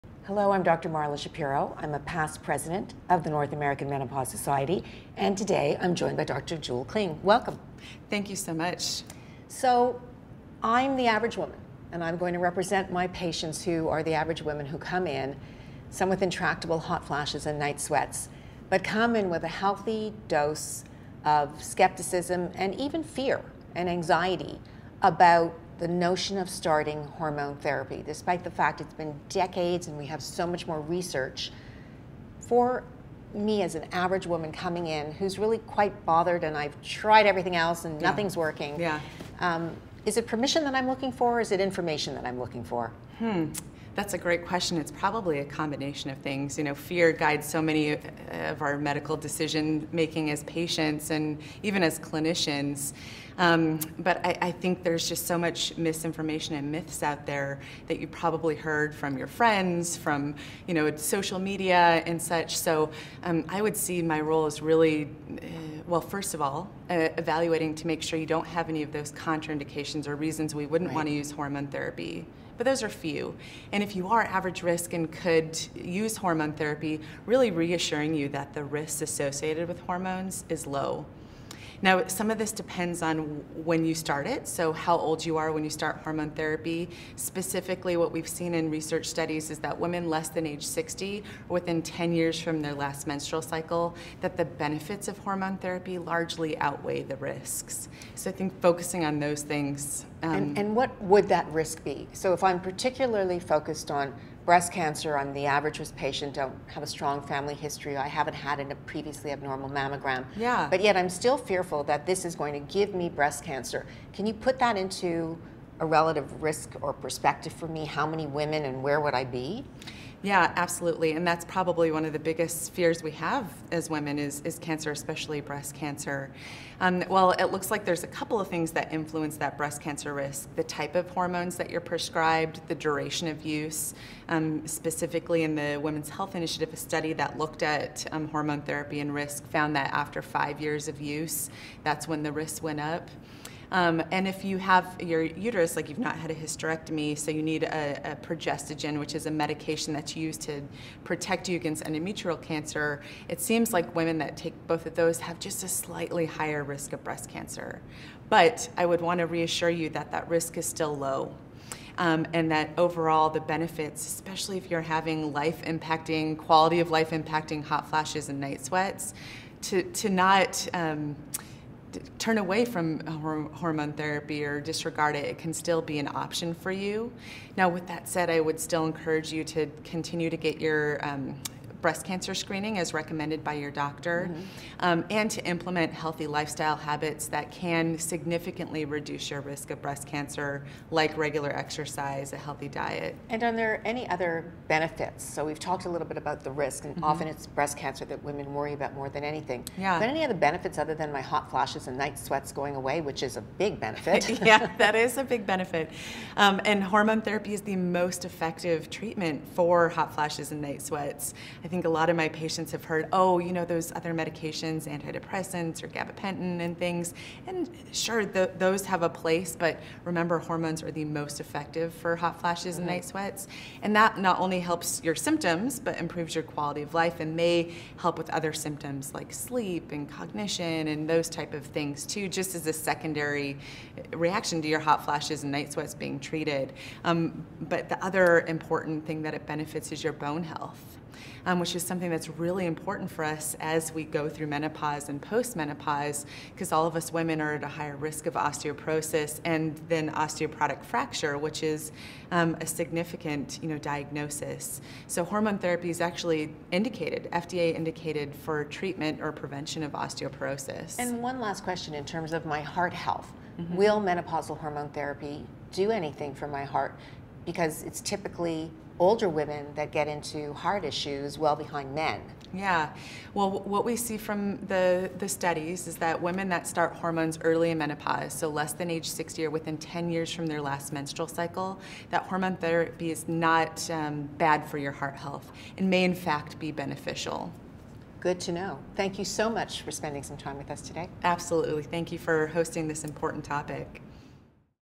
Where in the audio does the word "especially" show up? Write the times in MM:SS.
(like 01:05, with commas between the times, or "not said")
02:04, 02:44.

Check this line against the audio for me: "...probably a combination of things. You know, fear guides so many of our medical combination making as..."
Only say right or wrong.
wrong.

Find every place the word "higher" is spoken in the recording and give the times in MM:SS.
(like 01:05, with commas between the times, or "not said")
02:36, 04:07.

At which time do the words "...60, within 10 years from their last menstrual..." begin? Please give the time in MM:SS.
01:30.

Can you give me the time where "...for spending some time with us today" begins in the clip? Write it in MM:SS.
04:49.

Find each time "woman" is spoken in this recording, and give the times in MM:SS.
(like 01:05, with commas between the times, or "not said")
00:11, 00:34.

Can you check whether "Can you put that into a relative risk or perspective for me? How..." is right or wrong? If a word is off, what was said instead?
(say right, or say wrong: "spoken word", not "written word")
right.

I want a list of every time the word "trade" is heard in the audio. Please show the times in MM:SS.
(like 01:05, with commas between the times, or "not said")
not said.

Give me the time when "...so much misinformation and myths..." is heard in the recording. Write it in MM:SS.
00:55.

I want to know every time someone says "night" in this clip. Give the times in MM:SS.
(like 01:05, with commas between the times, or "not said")
00:17, 02:48, 03:22, 03:30, 03:42, 03:55.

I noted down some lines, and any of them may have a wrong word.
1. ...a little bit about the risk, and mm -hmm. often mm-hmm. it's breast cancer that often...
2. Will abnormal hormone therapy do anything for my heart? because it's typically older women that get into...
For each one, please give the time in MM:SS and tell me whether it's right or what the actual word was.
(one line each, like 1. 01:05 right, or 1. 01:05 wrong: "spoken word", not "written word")
1. 03:15 wrong: "women", not "often"
2. 04:23 wrong: "menopausal", not "abnormal".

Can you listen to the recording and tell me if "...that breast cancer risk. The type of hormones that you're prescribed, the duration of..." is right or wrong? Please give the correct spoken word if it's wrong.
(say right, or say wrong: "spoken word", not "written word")
right.